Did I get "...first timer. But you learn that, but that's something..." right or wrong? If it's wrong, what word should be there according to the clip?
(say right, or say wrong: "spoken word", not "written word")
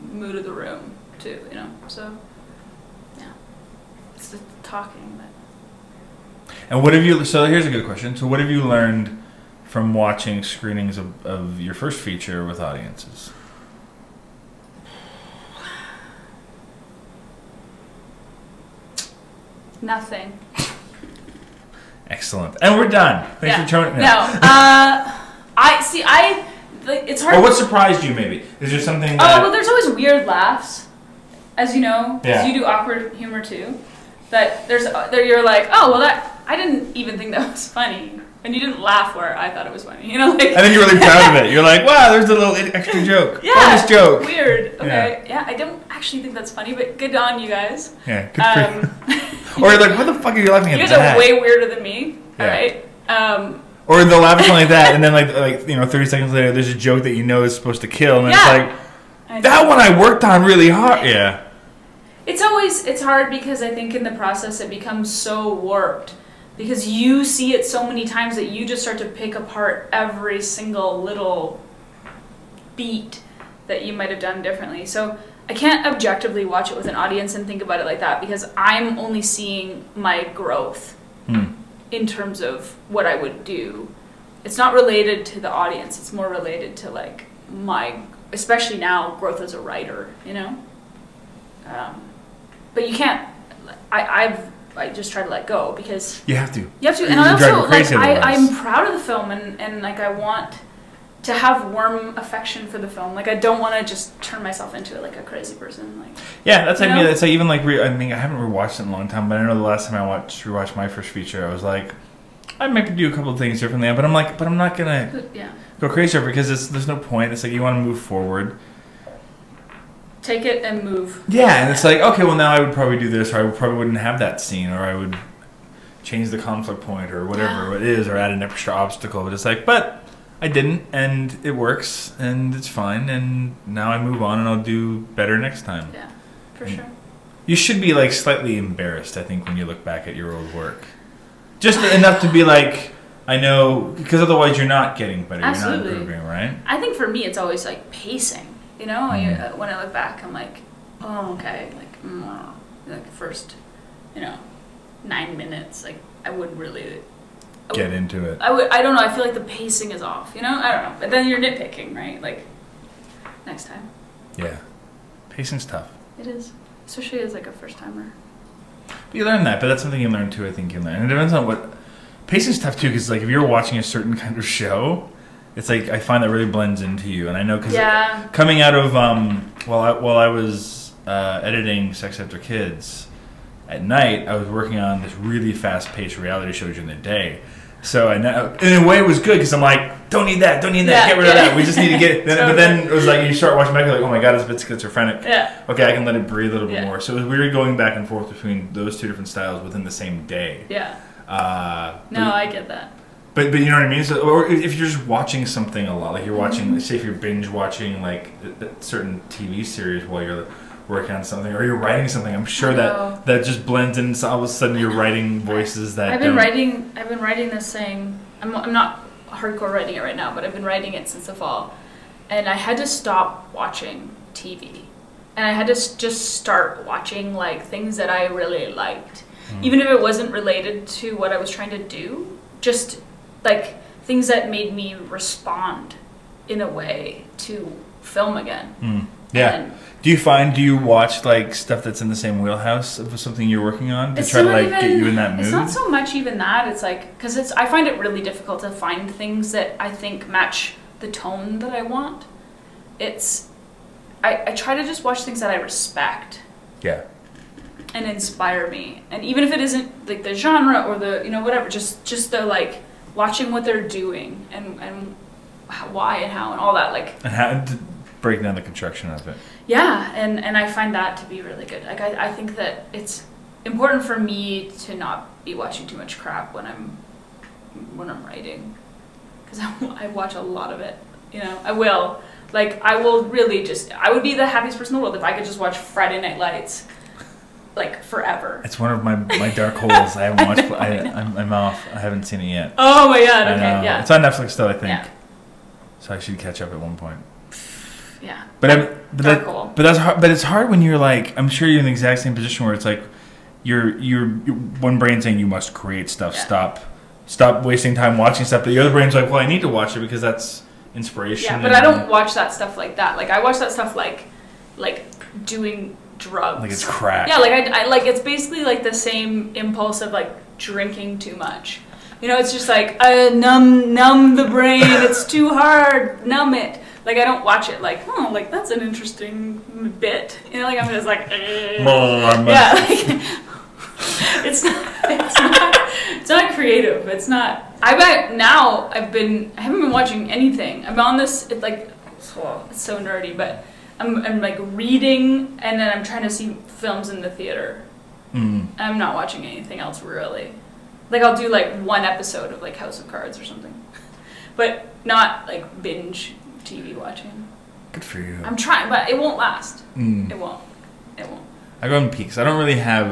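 right.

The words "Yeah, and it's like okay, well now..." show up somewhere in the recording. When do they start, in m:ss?
2:01.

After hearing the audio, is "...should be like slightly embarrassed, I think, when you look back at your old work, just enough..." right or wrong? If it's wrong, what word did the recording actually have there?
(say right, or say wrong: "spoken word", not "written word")
right.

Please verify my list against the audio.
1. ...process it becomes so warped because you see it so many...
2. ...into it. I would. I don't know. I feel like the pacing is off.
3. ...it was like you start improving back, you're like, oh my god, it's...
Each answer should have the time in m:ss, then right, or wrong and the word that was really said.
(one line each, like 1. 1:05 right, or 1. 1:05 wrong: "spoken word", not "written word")
1. 1:04 right
2. 2:37 right
3. 3:12 wrong: "watching", not "improving".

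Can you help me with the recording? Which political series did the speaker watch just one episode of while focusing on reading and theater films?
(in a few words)
House of Cards.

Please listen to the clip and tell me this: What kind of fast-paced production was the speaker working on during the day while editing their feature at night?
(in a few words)
Reality show.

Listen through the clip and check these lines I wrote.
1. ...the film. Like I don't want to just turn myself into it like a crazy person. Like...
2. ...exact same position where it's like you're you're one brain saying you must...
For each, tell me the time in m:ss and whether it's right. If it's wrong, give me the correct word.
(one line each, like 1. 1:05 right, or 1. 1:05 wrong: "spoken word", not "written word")
1. 1:42 right
2. 5:01 right.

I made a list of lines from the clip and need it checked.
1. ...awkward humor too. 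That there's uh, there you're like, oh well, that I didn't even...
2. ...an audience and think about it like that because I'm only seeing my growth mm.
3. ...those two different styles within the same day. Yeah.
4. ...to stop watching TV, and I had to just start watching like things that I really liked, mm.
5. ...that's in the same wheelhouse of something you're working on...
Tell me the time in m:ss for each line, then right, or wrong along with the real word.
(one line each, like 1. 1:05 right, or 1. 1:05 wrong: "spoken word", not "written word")
1. 0:32 right
2. 1:16 right
3. 3:18 right
4. 3:42 right
5. 4:01 right.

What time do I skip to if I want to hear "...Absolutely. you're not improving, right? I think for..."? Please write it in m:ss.
2:25.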